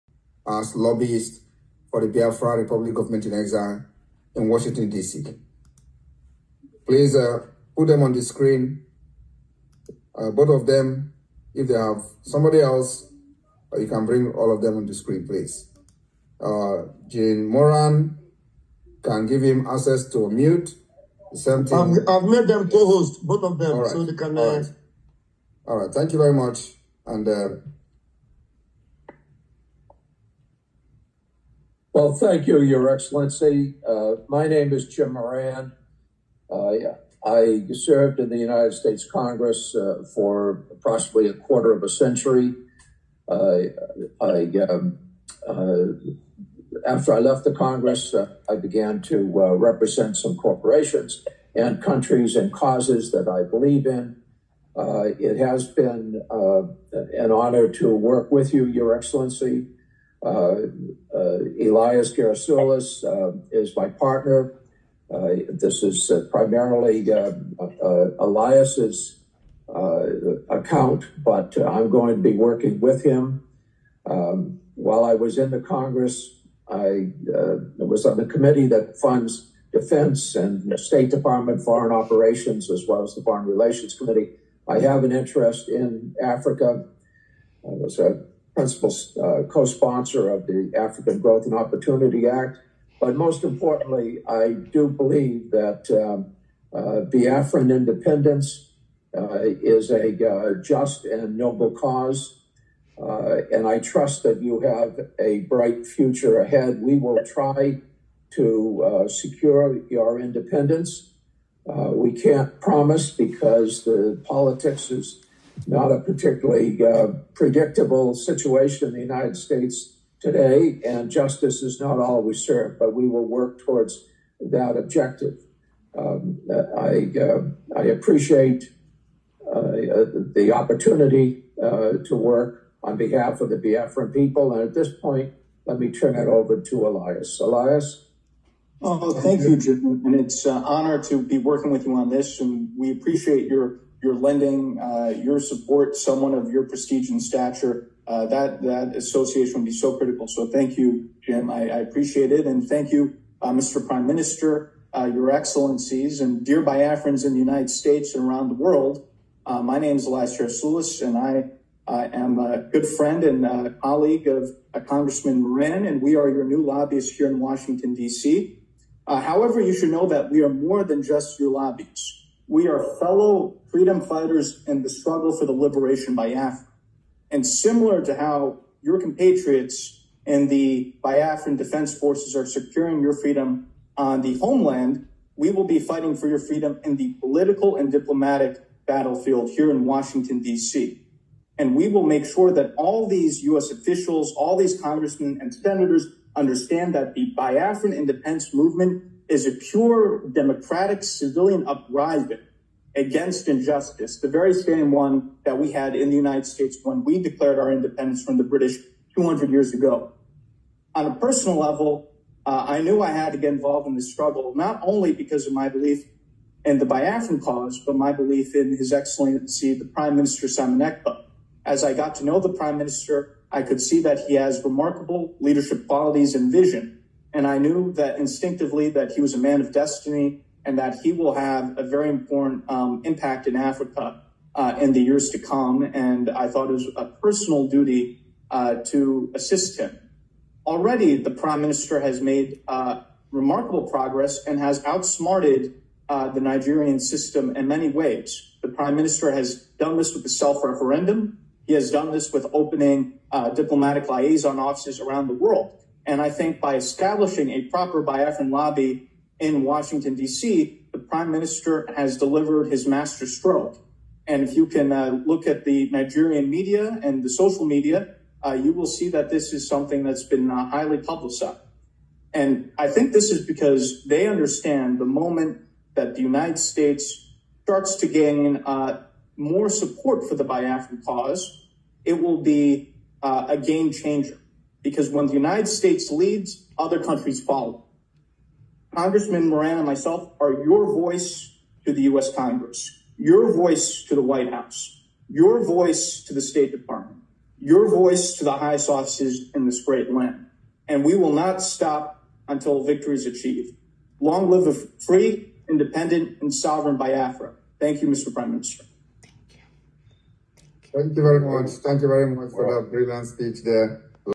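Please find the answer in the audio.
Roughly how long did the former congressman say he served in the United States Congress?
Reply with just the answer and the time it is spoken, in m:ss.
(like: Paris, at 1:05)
a quarter of a century, at 0:41.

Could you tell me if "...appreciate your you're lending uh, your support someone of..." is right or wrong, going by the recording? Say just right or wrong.
right.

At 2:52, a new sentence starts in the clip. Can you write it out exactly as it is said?
We are fellow freedom fighters in the struggle for the liberation Biafra.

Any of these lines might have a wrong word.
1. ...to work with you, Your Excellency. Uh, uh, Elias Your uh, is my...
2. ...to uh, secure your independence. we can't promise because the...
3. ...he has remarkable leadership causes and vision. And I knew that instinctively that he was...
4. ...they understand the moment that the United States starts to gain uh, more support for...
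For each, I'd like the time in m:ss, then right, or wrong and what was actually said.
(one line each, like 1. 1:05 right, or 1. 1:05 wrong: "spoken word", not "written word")
1. 0:57 wrong: "Garasoulis", not "Your"
2. 1:48 right
3. 3:44 wrong: "qualities", not "causes"
4. 4:34 right.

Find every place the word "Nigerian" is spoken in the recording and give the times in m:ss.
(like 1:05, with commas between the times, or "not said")
4:06, 4:25.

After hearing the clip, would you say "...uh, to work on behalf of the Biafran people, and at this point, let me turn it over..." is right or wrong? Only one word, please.
right.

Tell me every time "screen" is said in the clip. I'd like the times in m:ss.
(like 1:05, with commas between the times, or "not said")
0:08, 0:14.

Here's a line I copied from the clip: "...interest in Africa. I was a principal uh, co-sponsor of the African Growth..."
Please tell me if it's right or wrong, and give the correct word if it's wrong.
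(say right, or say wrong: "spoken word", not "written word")
right.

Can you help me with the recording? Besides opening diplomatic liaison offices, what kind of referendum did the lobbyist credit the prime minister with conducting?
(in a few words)
self referendum.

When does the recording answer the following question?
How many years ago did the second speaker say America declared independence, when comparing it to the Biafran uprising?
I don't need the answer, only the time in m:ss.
3:29.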